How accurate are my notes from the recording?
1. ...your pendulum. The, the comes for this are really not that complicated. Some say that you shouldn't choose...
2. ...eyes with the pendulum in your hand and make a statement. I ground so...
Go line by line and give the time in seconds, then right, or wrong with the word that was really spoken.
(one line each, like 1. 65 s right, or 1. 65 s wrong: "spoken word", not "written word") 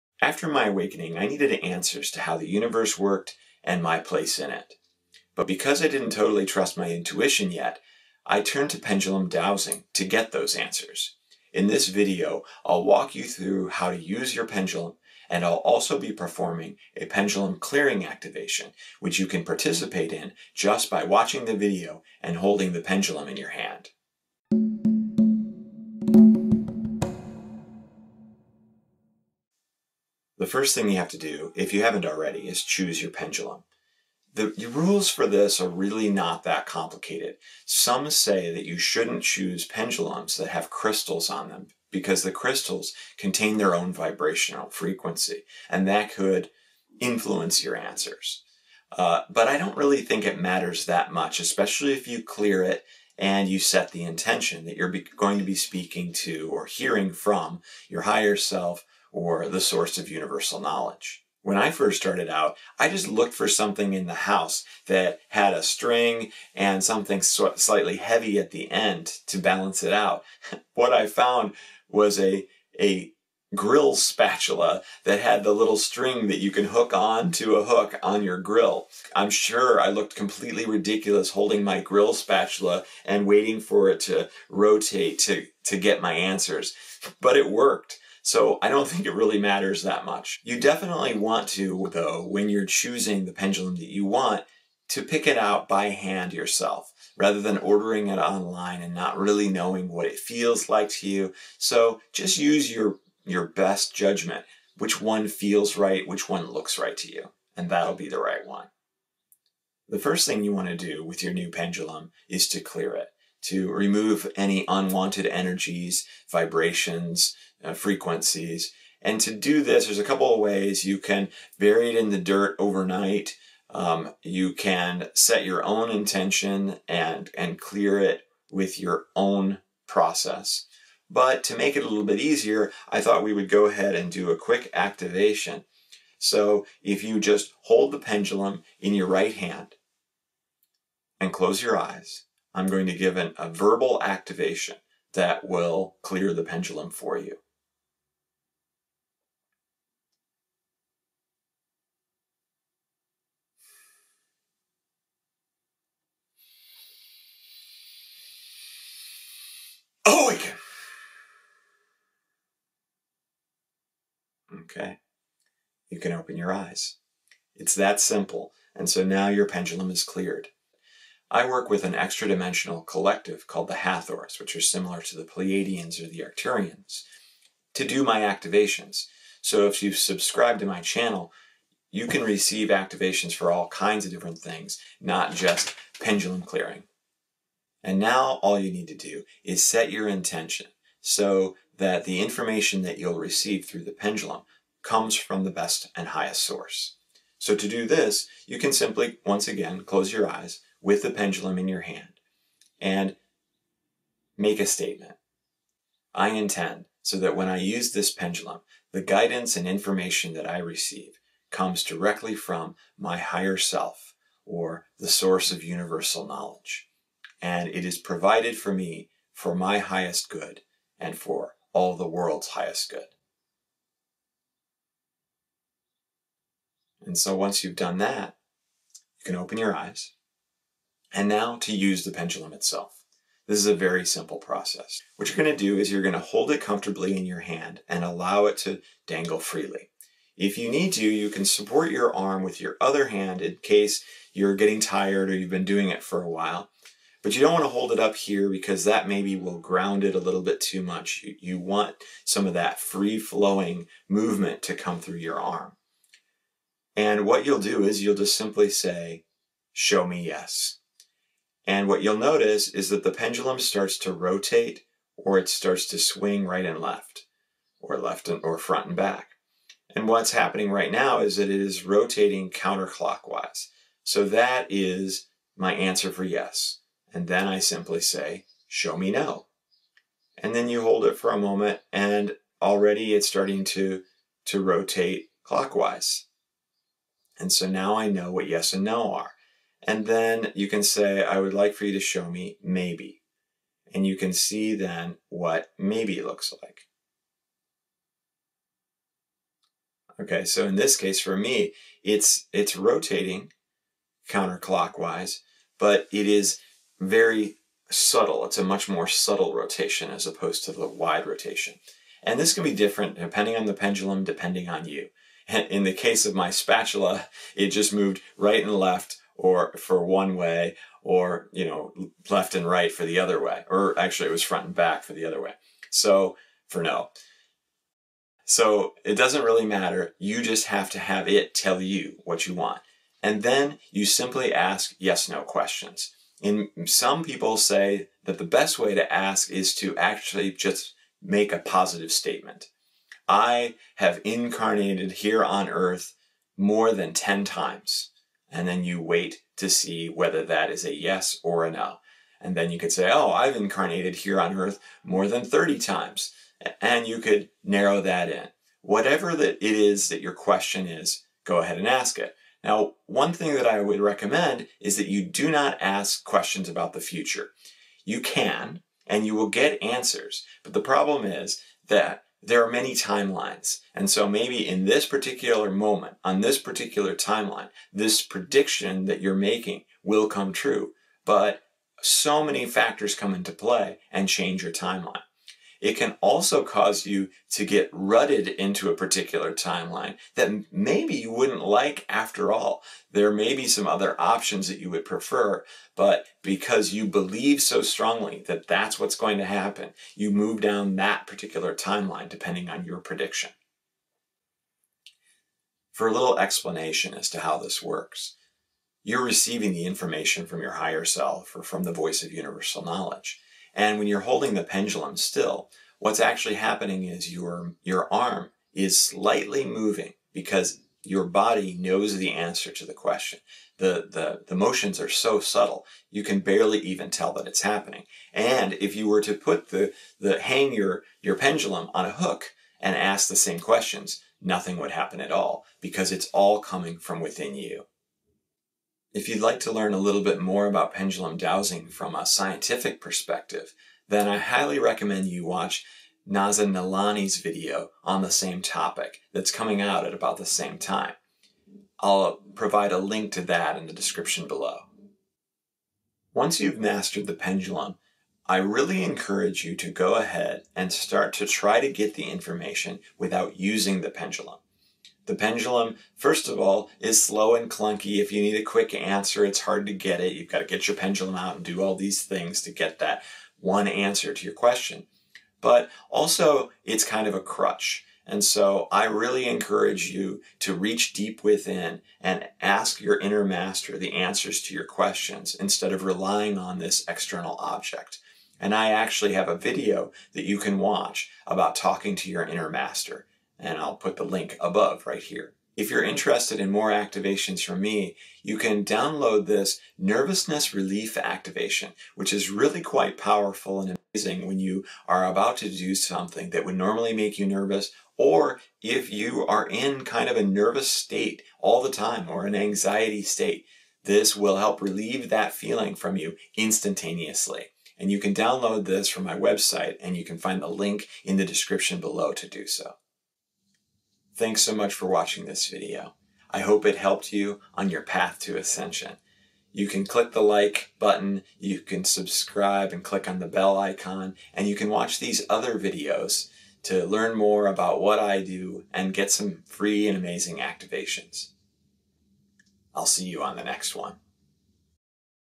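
1. 32 s wrong: "rules", not "comes"
2. 200 s wrong: "intend", not "ground".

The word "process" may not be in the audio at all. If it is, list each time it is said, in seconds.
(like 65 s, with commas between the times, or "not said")
129 s, 234 s.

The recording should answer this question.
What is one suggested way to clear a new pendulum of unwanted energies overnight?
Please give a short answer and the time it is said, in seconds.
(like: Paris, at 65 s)
bury it in the dirt, at 121 s.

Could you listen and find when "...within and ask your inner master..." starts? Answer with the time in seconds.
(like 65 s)
481 s.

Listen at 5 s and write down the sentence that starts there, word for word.
But because I didn't totally trust my intuition yet, I turned to pendulum dowsing to get those answers.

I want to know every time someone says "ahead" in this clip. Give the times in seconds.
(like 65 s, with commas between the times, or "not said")
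133 s, 361 s, 460 s.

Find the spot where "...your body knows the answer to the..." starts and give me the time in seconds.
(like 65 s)
421 s.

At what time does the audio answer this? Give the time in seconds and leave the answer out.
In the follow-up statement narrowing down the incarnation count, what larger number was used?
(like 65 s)
355 s.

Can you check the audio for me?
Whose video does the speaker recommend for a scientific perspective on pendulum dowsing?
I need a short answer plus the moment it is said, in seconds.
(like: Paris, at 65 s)
Naza Nalani, at 446 s.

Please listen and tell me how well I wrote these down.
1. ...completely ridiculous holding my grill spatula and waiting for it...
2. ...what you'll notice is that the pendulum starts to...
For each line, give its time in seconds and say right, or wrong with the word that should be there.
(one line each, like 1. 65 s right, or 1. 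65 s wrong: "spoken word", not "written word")
1. 80 s right
2. 261 s right.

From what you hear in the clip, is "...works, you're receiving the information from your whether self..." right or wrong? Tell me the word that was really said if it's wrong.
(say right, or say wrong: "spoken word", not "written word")
wrong: "higher", not "whether".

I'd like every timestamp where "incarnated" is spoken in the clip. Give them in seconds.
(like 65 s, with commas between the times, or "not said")
344 s, 353 s.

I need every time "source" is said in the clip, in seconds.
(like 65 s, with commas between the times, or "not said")
59 s, 196 s, 215 s.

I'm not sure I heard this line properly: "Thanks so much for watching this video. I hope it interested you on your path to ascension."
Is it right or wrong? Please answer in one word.
wrong.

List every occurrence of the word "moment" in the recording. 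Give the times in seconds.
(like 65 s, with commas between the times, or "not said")
281 s, 375 s.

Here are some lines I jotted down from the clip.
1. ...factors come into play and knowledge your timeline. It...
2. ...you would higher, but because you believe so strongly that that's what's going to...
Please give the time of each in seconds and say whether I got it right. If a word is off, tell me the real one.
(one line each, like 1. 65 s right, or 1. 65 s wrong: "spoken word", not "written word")
1. 382 s wrong: "change", not "knowledge"
2. 394 s wrong: "prefer", not "higher".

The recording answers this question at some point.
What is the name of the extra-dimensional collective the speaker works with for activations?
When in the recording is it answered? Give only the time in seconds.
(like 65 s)
173 s.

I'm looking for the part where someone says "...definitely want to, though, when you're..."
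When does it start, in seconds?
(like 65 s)
90 s.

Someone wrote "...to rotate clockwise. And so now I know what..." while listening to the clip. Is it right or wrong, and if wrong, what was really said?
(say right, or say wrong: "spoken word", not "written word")
right.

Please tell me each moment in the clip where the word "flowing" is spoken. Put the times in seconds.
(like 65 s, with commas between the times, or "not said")
252 s.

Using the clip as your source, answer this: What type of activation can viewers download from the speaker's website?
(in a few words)
nervousness relief.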